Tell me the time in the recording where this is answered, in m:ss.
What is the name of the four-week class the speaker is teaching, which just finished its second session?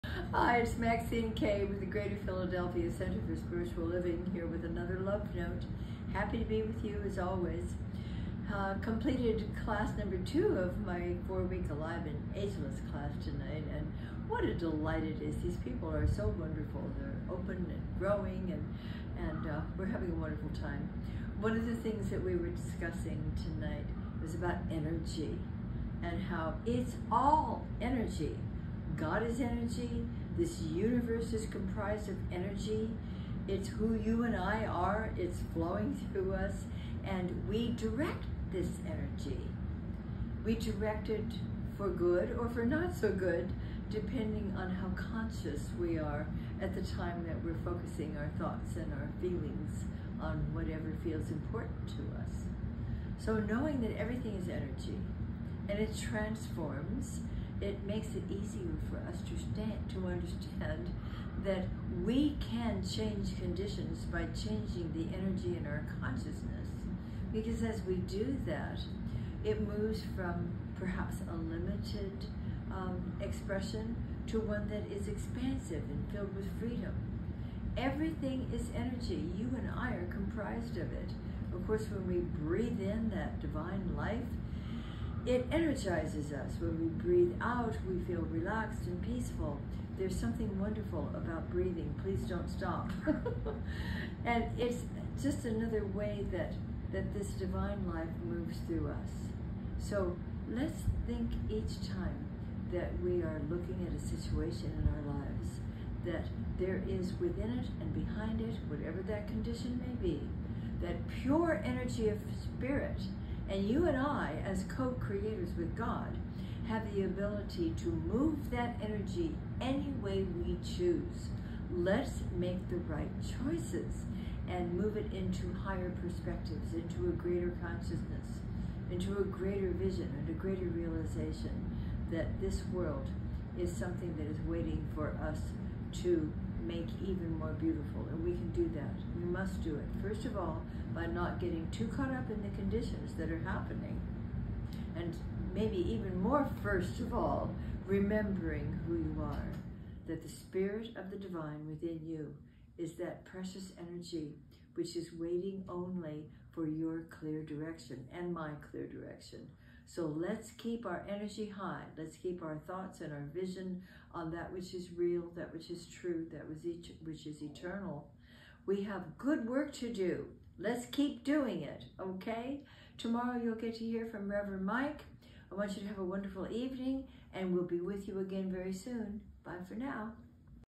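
0:11.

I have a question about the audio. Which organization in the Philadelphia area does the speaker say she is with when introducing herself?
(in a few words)
Greater Philadelphia Center for Spiritual Living.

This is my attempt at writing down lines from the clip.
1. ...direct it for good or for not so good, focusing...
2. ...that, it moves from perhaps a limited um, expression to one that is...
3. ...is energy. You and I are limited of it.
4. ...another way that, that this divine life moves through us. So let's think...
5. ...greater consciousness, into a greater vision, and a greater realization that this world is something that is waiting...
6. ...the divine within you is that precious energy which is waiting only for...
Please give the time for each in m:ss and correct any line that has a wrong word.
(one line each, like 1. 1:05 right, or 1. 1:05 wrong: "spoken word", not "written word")
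1. 0:40 wrong: "depending", not "focusing"
2. 1:08 right
3. 1:18 wrong: "comprised", not "limited"
4. 1:35 right
5. 2:07 right
6. 2:31 right.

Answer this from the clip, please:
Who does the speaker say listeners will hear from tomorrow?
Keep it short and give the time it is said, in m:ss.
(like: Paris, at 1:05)
Reverend Mike, at 2:54.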